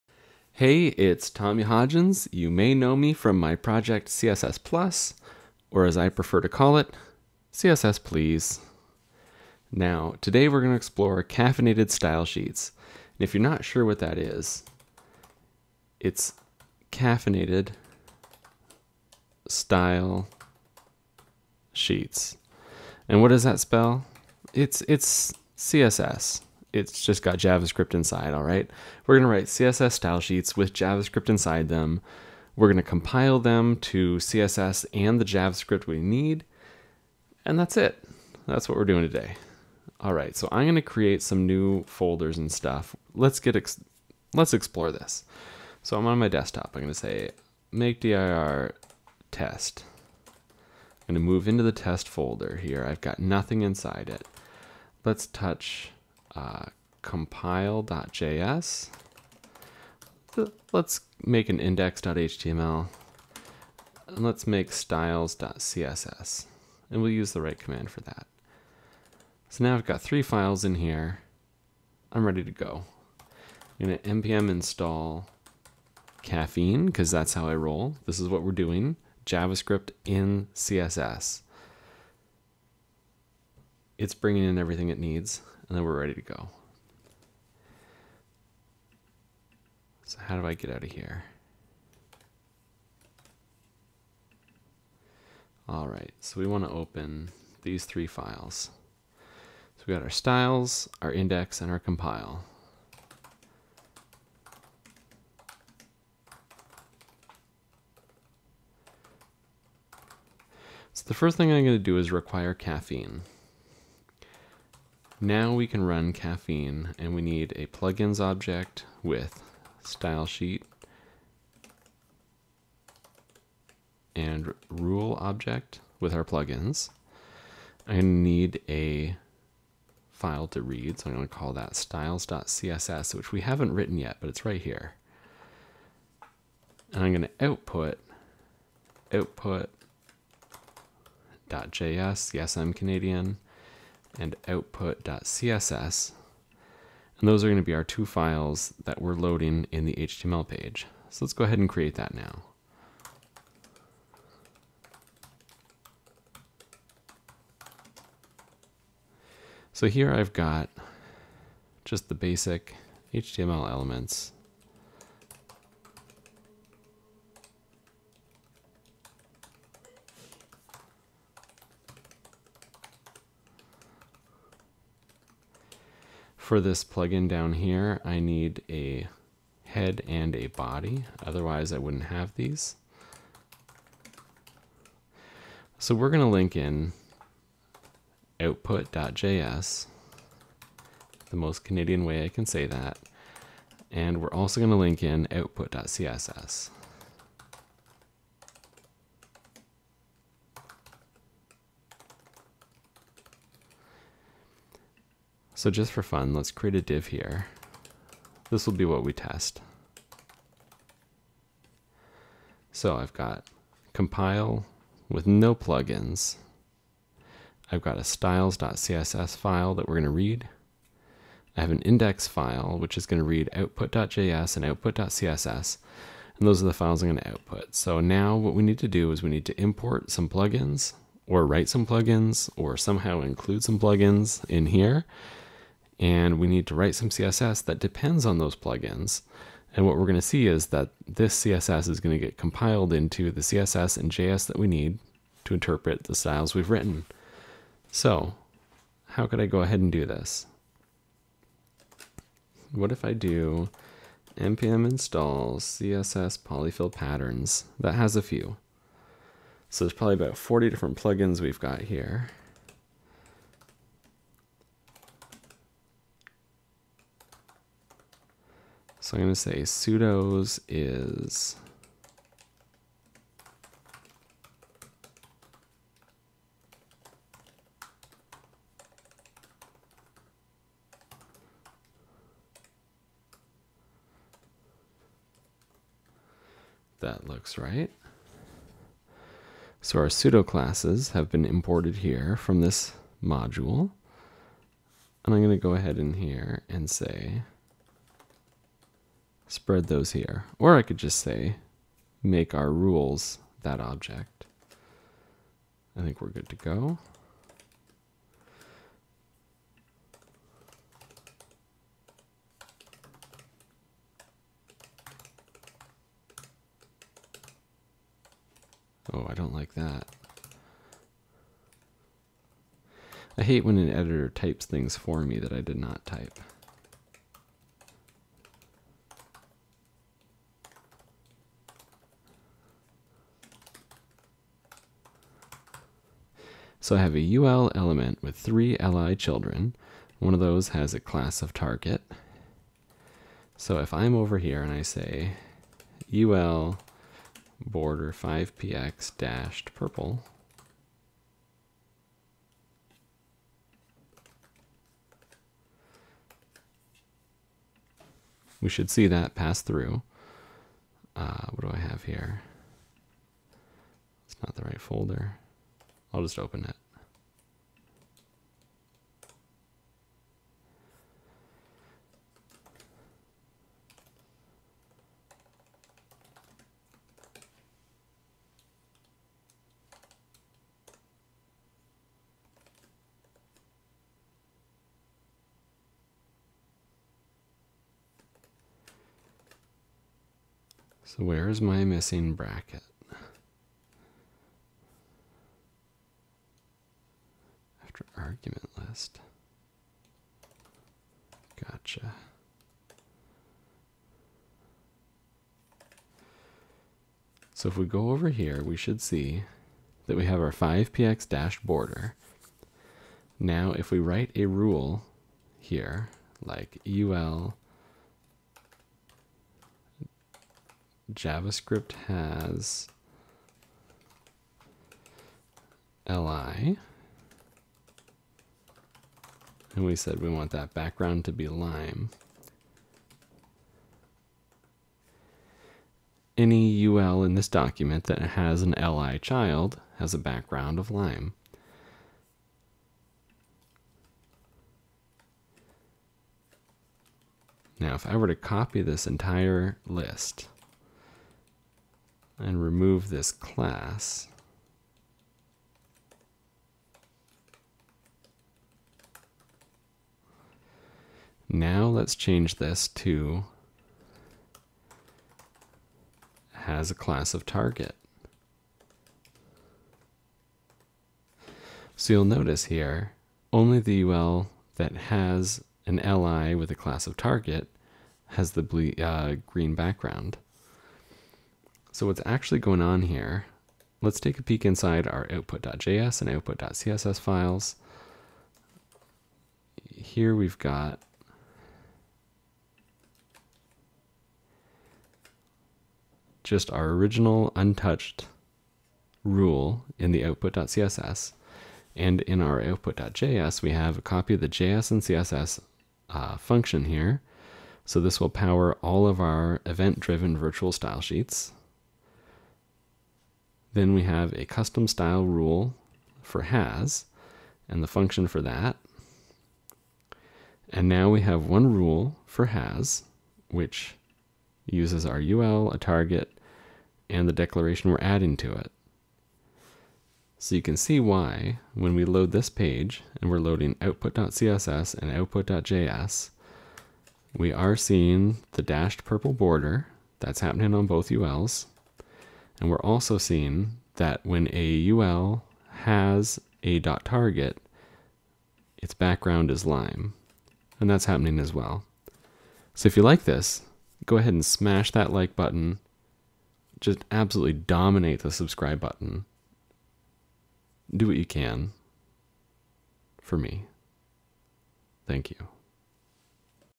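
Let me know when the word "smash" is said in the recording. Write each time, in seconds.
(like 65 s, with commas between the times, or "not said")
554 s.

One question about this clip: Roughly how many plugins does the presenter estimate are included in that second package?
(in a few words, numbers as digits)
40.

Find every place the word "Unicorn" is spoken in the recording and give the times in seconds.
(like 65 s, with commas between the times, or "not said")
not said.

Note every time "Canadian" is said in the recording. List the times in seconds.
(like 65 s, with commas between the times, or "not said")
142 s, 191 s.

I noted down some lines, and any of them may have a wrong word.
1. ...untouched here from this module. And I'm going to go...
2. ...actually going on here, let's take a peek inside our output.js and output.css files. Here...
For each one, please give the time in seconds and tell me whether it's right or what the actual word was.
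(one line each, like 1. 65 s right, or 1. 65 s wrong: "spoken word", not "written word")
1. 291 s wrong: "imported", not "untouched"
2. 482 s right.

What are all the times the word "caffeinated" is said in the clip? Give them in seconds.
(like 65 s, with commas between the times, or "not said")
11 s, 16 s.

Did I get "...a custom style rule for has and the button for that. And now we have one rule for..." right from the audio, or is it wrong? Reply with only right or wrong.
wrong.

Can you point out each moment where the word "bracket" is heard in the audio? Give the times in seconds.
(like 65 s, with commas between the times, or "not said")
392 s.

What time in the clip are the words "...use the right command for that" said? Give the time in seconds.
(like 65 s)
67 s.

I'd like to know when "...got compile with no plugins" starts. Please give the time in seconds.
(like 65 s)
213 s.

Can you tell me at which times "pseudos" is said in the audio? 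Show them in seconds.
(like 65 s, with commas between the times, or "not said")
269 s, 290 s.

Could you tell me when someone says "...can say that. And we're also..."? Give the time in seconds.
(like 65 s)
192 s.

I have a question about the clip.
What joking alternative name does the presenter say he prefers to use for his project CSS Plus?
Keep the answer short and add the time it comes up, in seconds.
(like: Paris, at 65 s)
CSS Please, at 7 s.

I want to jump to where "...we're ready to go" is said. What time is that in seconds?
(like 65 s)
85 s.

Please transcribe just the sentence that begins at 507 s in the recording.
So this will power all of our event-driven virtual style sheets.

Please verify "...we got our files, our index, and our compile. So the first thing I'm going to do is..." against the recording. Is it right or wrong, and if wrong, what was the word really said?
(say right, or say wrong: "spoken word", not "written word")
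wrong: "styles", not "files".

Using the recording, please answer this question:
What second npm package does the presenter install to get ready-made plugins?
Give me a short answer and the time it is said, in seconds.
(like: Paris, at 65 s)
css polyfill patterns, at 255 s.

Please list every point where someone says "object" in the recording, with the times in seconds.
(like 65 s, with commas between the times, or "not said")
118 s, 125 s, 303 s.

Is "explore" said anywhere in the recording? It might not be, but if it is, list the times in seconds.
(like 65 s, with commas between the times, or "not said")
10 s, 44 s.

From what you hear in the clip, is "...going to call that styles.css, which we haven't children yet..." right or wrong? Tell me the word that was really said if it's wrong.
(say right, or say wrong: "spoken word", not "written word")
wrong: "written", not "children".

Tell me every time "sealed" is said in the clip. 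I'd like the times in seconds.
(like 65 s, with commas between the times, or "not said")
not said.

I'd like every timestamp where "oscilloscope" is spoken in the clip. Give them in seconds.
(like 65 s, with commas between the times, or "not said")
not said.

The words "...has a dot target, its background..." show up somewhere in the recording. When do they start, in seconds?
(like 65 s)
545 s.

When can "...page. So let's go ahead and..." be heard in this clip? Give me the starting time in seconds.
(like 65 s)
150 s.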